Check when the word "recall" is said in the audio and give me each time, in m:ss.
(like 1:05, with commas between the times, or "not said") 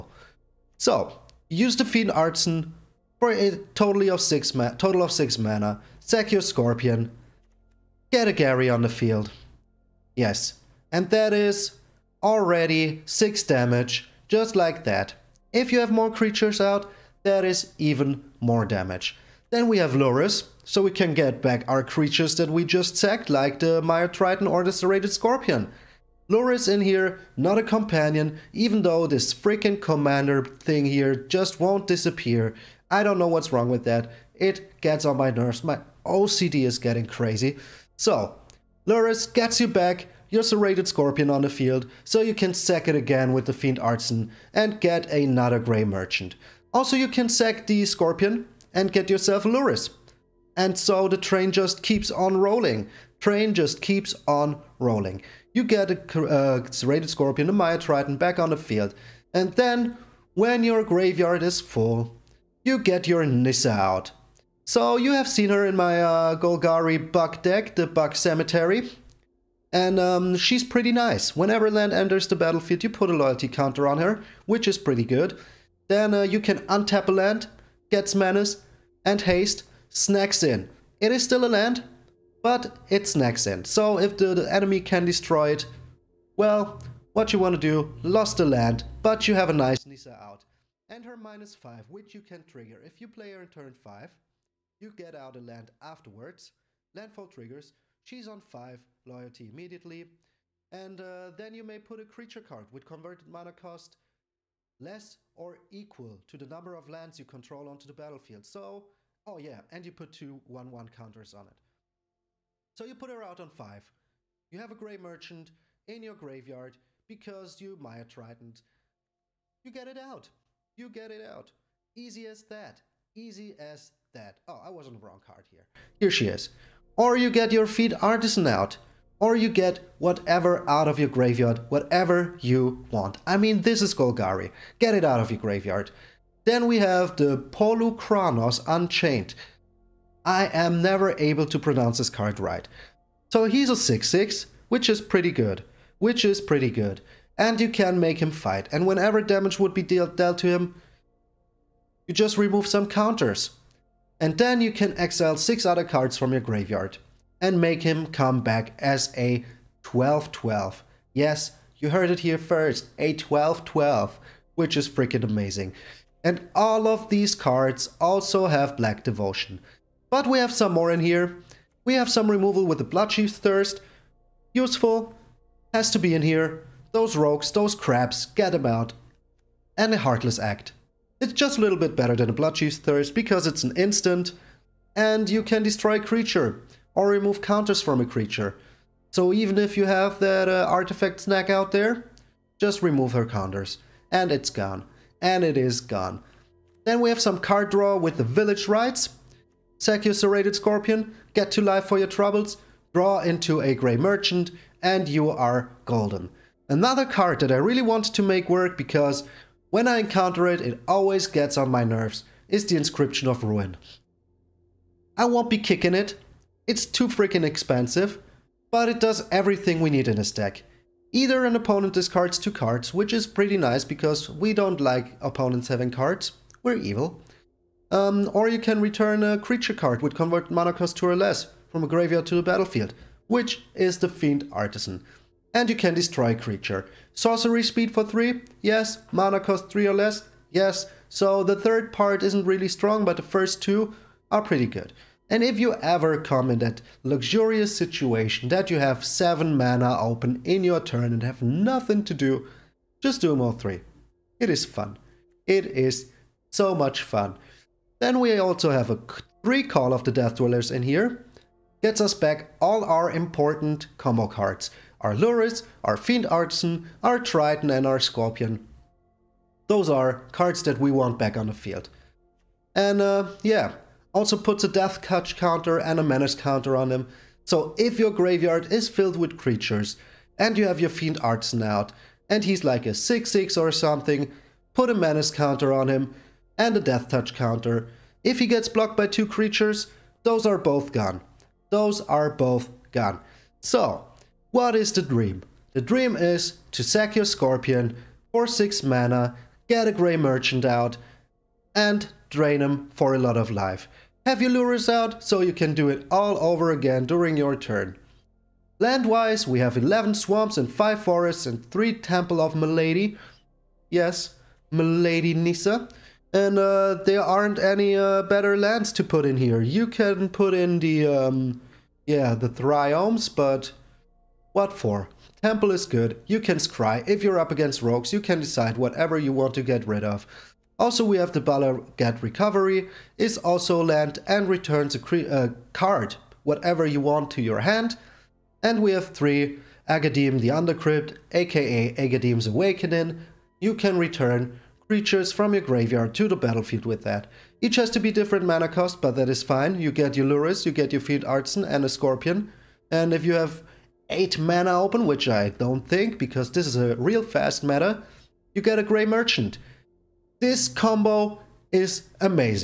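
4:19.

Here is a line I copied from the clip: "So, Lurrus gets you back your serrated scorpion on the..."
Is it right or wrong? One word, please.
right.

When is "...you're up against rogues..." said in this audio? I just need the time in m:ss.
5:27.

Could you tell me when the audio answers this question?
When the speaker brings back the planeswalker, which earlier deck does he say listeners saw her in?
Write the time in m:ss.
1:07.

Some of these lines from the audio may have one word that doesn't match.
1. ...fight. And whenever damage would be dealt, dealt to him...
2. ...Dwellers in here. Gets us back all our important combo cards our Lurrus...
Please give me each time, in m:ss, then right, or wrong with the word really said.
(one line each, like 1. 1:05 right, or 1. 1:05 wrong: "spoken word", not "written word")
1. 2:28 right
2. 4:20 right.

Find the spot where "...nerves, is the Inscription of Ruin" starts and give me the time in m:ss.
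3:31.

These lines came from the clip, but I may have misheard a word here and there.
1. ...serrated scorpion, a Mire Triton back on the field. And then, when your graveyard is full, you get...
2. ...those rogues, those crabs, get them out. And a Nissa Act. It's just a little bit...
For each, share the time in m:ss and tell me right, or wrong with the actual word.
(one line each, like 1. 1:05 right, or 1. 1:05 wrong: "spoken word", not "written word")
1. 0:56 right
2. 2:56 wrong: "Heartless", not "Nissa".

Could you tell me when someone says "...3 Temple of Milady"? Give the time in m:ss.
5:11.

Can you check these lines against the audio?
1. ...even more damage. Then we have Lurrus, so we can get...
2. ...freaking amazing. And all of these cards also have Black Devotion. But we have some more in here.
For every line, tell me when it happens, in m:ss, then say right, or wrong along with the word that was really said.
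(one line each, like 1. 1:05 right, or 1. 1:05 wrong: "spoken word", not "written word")
1. 0:17 right
2. 2:44 right.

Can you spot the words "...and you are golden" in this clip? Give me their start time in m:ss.
3:24.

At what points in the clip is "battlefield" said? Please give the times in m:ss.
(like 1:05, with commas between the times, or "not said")
1:12, 1:47, 3:52, 5:46.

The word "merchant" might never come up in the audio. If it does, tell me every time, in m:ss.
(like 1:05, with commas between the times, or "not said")
0:45, 1:54, 3:23, 5:00, 5:59.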